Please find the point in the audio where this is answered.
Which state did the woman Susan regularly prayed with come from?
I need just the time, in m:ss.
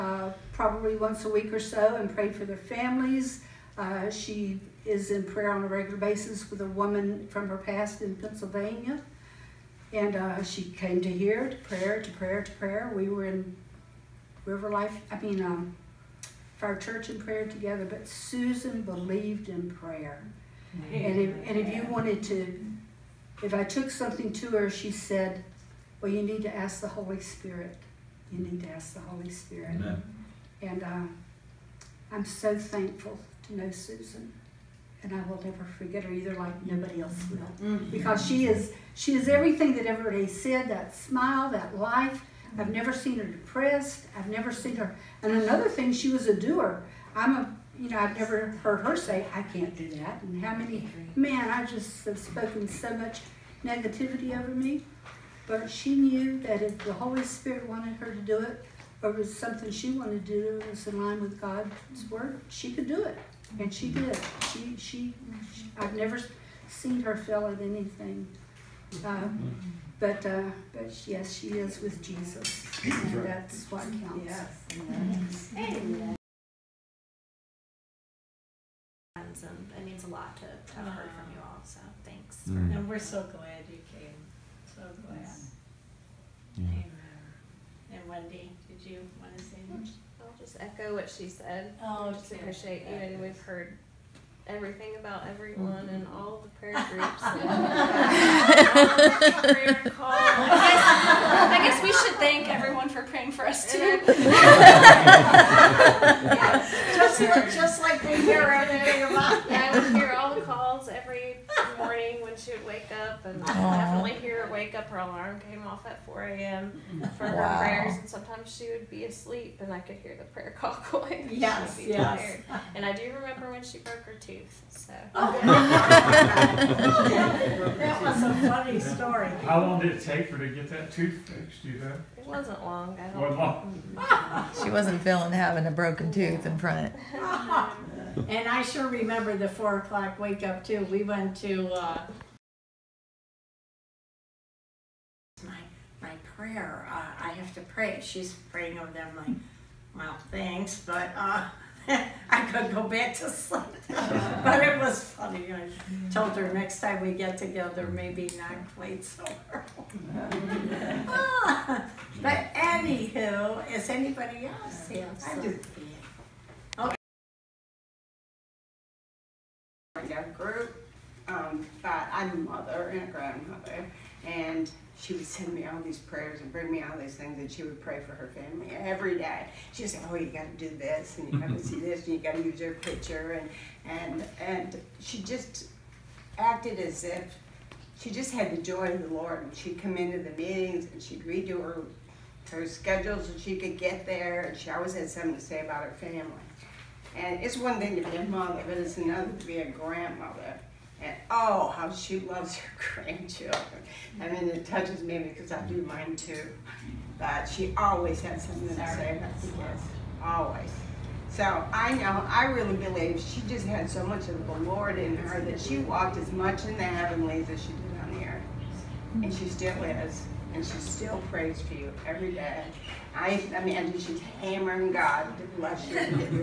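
0:08.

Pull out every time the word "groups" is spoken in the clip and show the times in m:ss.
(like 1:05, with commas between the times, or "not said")
1:36, 2:50.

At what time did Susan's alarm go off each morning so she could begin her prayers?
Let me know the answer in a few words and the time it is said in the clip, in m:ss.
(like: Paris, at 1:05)
4 a.m., at 1:56.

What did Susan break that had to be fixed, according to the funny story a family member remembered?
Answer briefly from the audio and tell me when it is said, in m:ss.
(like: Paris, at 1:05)
Her tooth, at 2:04.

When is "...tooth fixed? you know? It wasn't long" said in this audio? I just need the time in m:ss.
2:10.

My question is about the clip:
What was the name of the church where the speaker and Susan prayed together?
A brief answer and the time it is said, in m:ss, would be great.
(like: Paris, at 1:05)
River Life, at 0:14.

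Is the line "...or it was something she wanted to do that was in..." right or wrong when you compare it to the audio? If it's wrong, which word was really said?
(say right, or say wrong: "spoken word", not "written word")
right.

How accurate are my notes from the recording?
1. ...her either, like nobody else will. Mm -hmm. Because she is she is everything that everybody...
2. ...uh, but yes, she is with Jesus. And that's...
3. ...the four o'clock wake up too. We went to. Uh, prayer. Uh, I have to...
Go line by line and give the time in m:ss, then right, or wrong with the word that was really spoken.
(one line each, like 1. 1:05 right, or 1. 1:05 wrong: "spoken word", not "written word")
1. 0:36 right
2. 1:10 right
3. 2:19 right.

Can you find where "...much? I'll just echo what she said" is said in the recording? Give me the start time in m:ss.
1:29.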